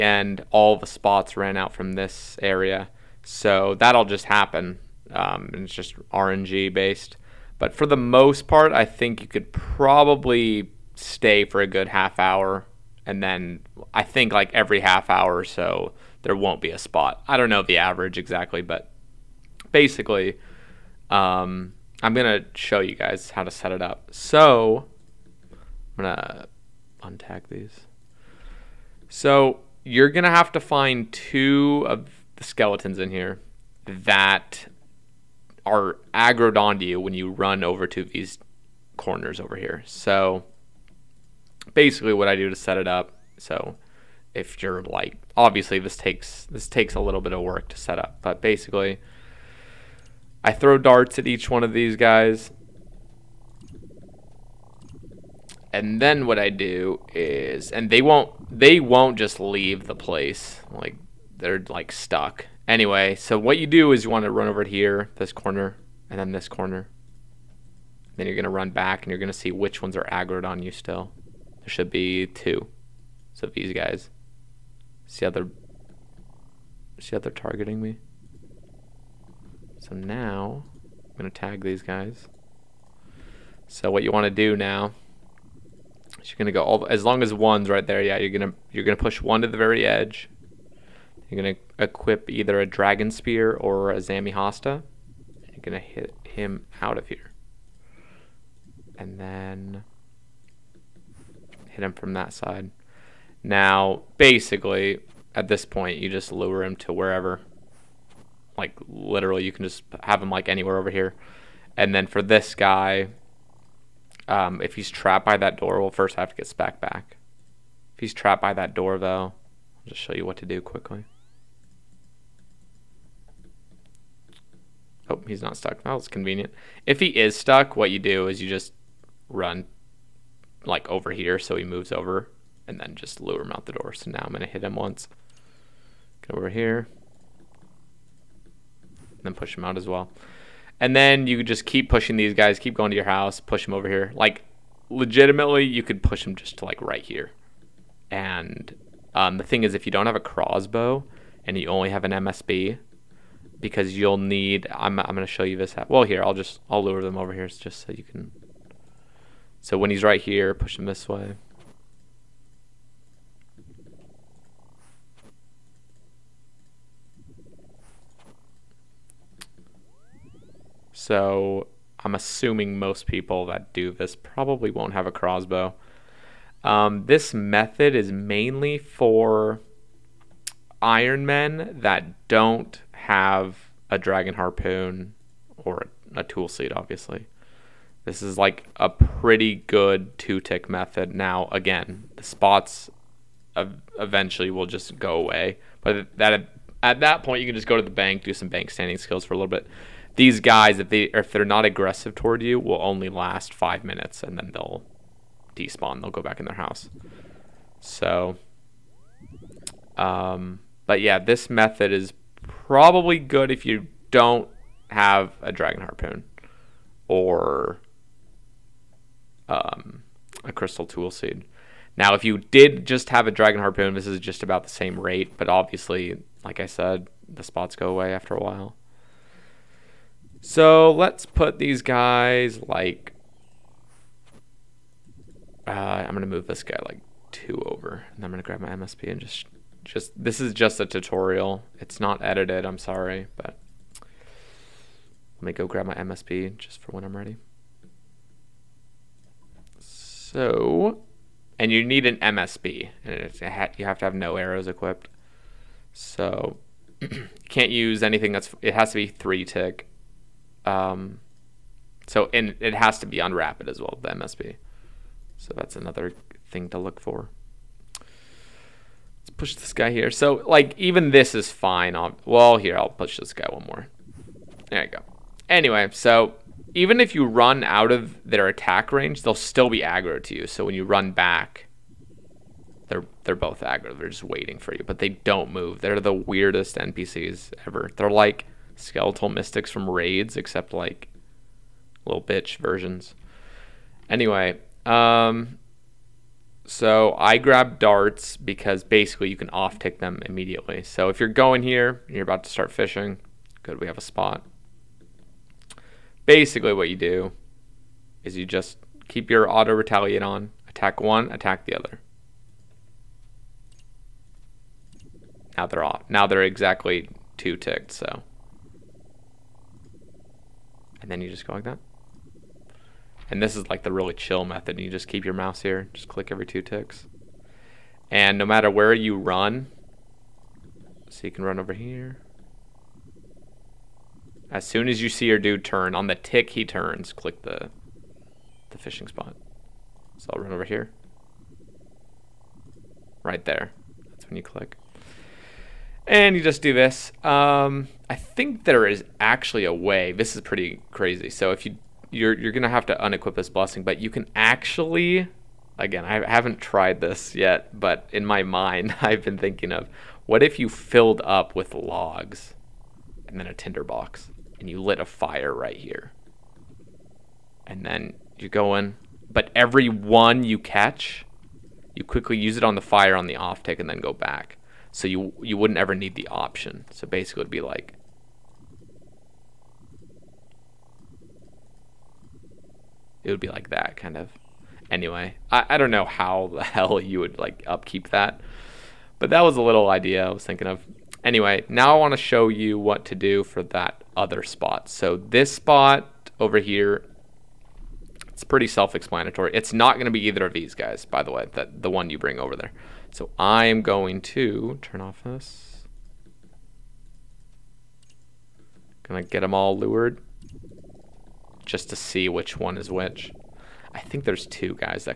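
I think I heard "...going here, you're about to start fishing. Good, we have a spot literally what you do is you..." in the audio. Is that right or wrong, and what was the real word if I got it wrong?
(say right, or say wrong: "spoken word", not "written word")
wrong: "basically", not "literally".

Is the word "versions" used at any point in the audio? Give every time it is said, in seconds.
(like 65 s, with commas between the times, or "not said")
292 s.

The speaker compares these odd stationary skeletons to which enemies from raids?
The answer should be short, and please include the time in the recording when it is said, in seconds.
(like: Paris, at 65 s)
skeletal mystics, at 288 s.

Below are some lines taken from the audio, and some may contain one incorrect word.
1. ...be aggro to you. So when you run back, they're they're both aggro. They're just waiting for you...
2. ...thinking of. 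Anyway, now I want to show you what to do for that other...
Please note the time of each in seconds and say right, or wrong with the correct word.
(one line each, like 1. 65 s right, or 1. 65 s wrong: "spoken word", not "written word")
1. 279 s right
2. 390 s right.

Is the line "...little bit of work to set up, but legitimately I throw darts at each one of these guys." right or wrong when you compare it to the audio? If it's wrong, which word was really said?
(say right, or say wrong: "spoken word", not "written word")
wrong: "basically", not "legitimately".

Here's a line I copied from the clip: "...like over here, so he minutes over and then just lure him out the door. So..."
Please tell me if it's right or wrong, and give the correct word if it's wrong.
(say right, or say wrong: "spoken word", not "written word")
wrong: "moves", not "minutes".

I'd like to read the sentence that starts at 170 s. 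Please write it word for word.
So I'm assuming most people that do this probably won't have a crossbow.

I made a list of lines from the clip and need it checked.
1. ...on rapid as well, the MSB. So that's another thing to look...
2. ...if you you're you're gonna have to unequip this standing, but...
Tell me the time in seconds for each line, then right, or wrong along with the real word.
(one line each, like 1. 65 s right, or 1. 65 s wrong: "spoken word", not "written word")
1. 263 s right
2. 351 s wrong: "blessing", not "standing".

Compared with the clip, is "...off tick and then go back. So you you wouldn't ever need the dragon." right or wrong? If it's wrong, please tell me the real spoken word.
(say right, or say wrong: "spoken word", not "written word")
wrong: "option", not "dragon".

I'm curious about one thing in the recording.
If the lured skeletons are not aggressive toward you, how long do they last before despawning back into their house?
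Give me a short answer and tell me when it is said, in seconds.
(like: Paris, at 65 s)
5 minutes, at 203 s.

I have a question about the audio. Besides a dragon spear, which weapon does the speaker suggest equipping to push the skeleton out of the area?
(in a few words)
Zammy hasta.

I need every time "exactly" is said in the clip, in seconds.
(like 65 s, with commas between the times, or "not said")
18 s, 316 s.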